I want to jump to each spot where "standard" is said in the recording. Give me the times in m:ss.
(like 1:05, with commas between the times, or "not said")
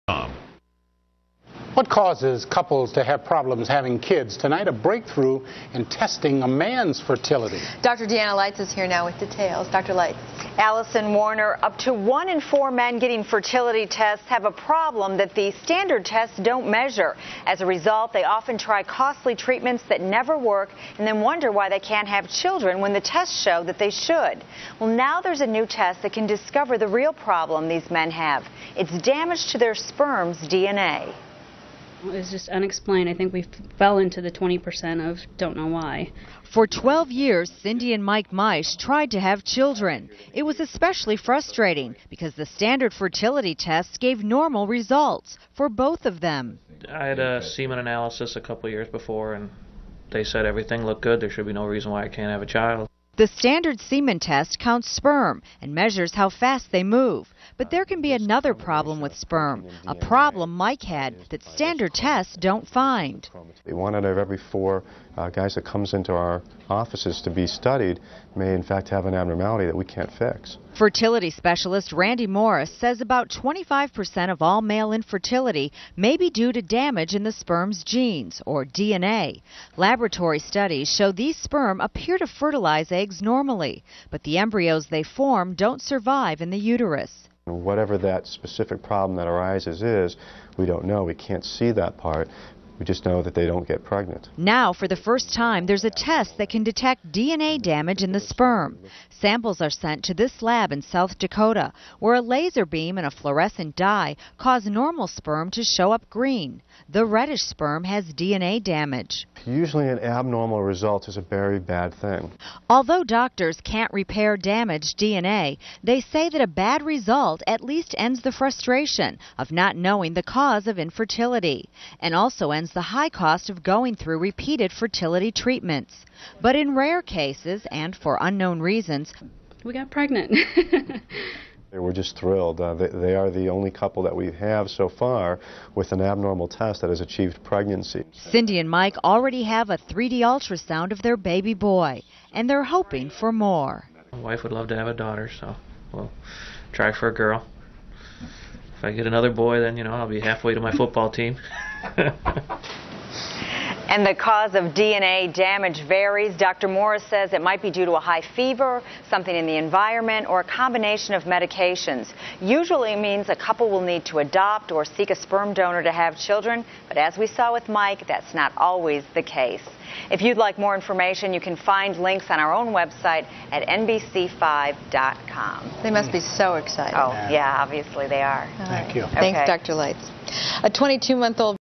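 0:15, 0:42, 0:53, 1:01.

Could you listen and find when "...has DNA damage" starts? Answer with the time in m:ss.
1:47.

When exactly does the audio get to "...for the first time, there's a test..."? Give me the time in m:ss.
1:34.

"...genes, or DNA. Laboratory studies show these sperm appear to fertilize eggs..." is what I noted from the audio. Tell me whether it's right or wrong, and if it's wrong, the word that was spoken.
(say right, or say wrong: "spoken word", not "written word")
right.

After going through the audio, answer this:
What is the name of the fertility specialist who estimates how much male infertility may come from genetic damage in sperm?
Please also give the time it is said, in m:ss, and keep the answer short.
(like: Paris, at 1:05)
Randy Morris, at 1:11.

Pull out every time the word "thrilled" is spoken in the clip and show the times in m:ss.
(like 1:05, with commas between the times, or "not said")
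2:12.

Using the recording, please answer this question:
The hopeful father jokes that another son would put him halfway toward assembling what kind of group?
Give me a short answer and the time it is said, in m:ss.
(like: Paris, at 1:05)
Football team, at 2:30.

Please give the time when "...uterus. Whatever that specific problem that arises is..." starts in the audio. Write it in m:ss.
1:26.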